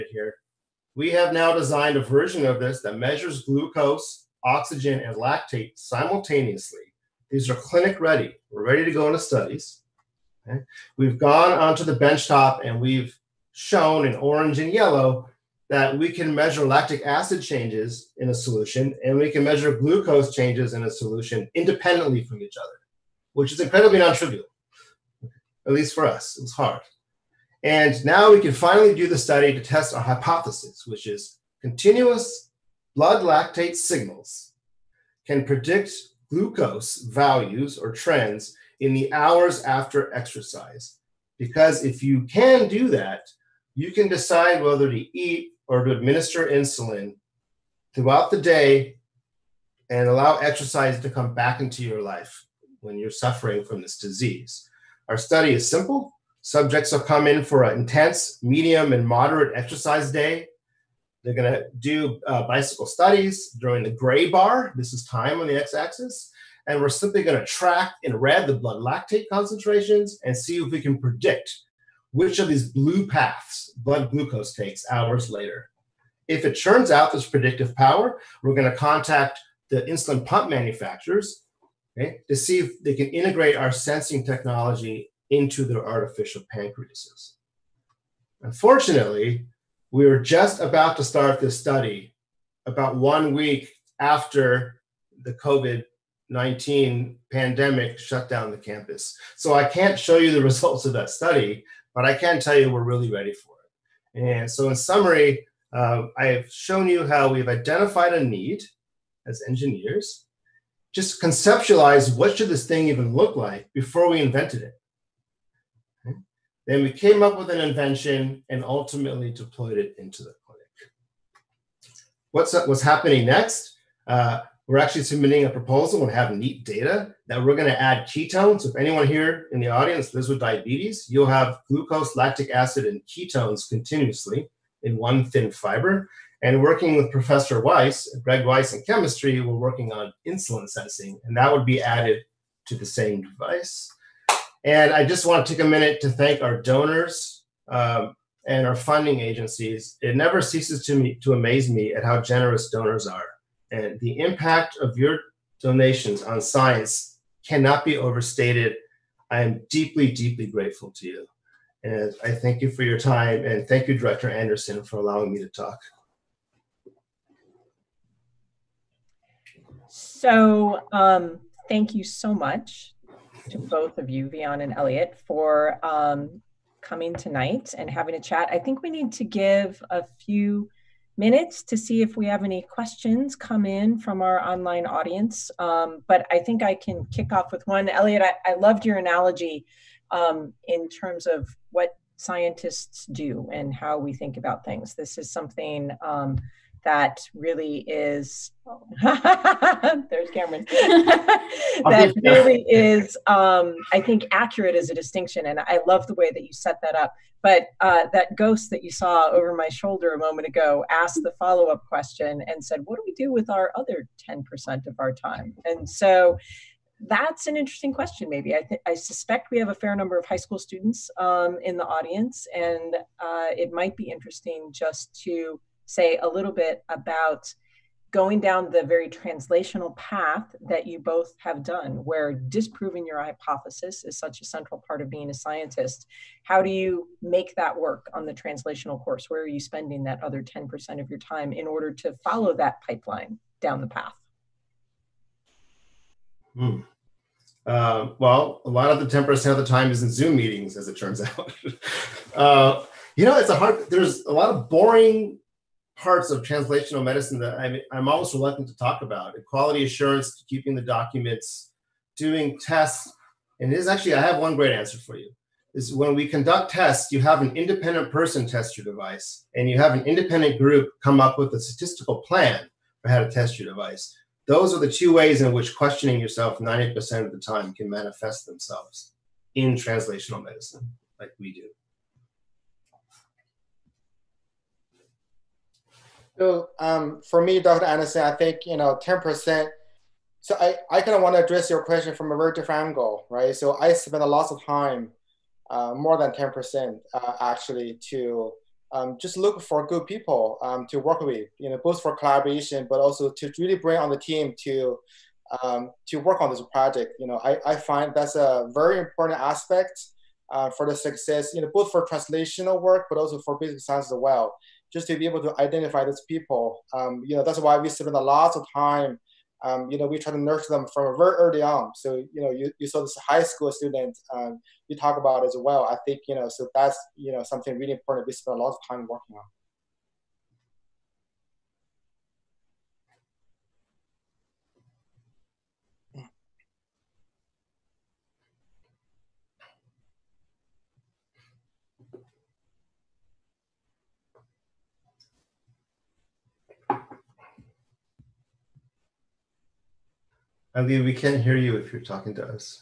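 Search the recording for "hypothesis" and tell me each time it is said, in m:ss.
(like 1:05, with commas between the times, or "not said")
0:30, 3:53.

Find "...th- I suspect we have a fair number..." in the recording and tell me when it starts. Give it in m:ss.
3:38.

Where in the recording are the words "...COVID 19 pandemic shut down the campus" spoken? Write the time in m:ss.
1:35.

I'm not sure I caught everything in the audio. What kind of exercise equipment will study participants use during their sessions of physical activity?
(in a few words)
bicycle.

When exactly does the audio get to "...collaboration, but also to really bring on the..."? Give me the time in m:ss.
5:02.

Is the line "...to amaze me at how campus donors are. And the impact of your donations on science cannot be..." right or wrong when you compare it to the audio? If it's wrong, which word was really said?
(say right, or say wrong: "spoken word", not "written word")
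wrong: "generous", not "campus".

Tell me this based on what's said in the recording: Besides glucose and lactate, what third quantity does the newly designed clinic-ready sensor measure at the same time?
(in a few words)
oxygen.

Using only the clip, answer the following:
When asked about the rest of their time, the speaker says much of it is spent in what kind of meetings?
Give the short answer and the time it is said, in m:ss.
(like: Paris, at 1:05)
Zoom meetings, at 4:10.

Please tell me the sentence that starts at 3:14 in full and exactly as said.
This is something um, that really is oh.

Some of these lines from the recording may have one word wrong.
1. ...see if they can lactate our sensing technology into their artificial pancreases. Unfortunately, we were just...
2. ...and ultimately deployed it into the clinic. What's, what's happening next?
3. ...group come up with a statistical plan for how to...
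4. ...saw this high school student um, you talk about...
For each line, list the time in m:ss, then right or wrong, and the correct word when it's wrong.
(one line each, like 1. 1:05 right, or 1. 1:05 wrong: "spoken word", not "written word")
1. 1:22 wrong: "integrate", not "lactate"
2. 1:58 right
3. 4:30 right
4. 5:22 right.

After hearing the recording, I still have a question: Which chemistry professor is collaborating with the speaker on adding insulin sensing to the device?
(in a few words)
Greg Weiss.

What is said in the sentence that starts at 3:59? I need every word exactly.
Where are you spending that other 10% of your time in order to follow that pipeline down the path?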